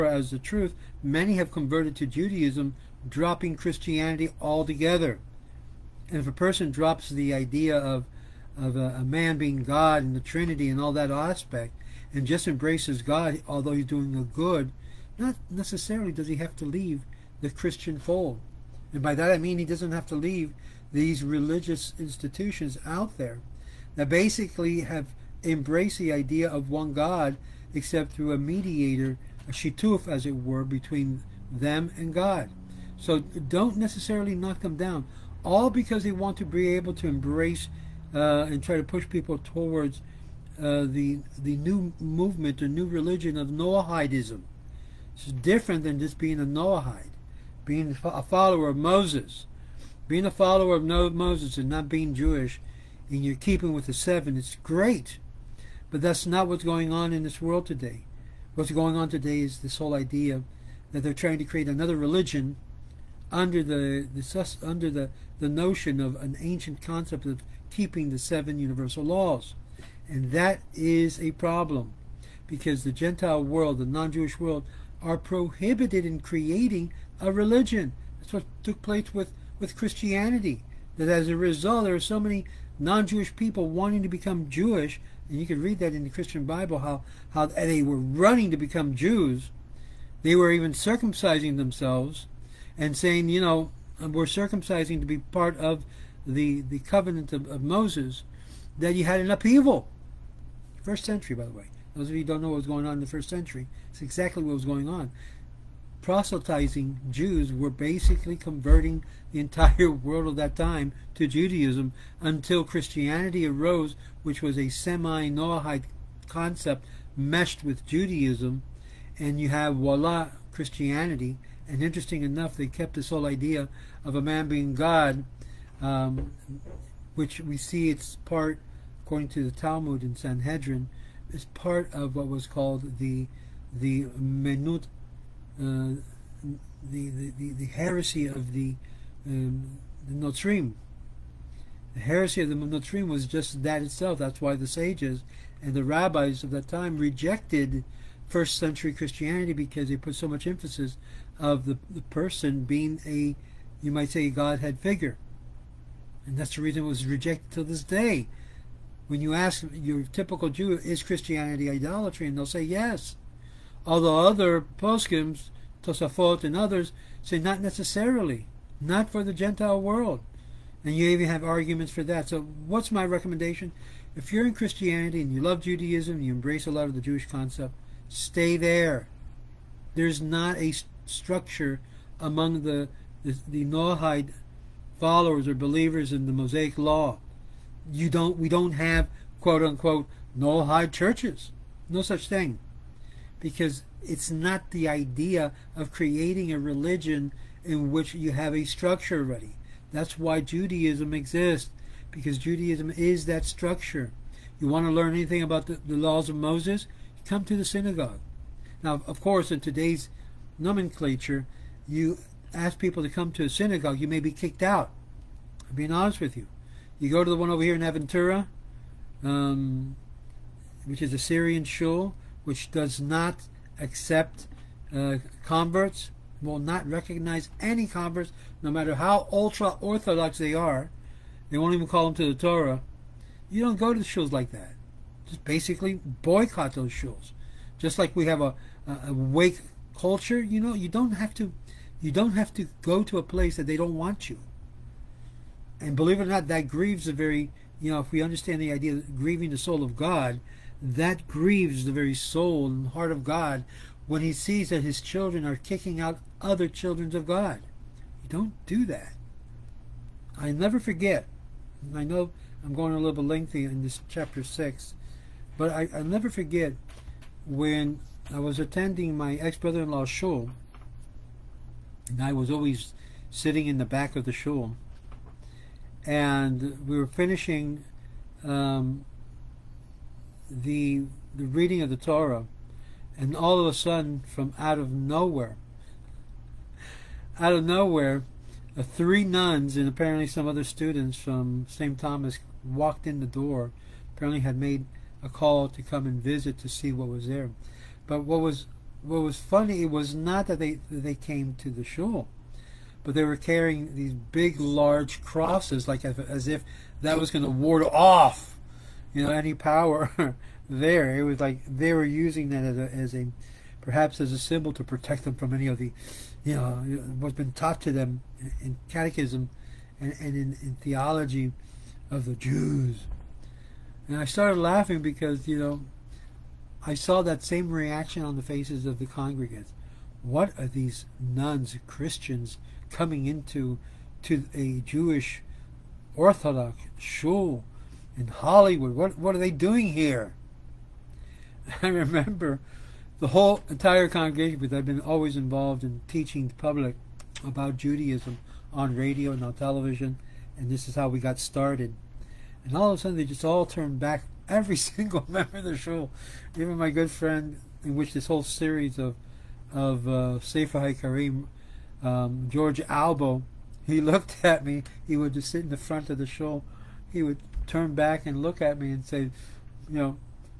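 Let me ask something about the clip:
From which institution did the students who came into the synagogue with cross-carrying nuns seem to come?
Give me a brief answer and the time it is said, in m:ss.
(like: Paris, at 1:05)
St. Thomas, at 4:51.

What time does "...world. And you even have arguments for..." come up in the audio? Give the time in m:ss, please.
2:49.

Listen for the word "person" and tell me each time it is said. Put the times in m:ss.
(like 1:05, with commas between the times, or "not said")
0:06, 2:32.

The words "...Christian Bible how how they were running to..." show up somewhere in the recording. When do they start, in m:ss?
1:26.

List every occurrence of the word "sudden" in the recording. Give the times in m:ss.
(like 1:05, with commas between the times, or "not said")
4:43, 5:53.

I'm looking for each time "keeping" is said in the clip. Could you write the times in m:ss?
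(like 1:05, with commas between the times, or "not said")
0:53, 1:07.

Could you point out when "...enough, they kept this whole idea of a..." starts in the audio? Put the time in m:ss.
2:02.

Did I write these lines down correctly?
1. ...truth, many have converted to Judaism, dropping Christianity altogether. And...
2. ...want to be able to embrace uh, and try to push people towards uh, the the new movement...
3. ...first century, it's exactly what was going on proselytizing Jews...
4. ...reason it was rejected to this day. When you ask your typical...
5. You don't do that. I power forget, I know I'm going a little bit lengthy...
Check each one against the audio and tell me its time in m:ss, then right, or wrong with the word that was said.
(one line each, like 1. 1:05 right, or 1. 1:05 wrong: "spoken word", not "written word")
1. 0:00 right
2. 0:36 right
3. 1:43 right
4. 2:36 right
5. 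4:18 wrong: "never", not "power".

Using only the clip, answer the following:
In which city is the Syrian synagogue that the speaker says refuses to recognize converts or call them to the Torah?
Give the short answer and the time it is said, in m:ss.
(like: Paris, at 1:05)
Aventura, at 3:37.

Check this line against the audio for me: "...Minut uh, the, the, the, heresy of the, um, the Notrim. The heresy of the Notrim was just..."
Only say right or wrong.
right.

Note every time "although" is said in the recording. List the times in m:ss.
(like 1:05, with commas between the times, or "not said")
0:13, 2:43.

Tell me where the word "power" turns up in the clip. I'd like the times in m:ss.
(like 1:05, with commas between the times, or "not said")
5:09.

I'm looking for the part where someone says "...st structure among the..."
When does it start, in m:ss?
3:00.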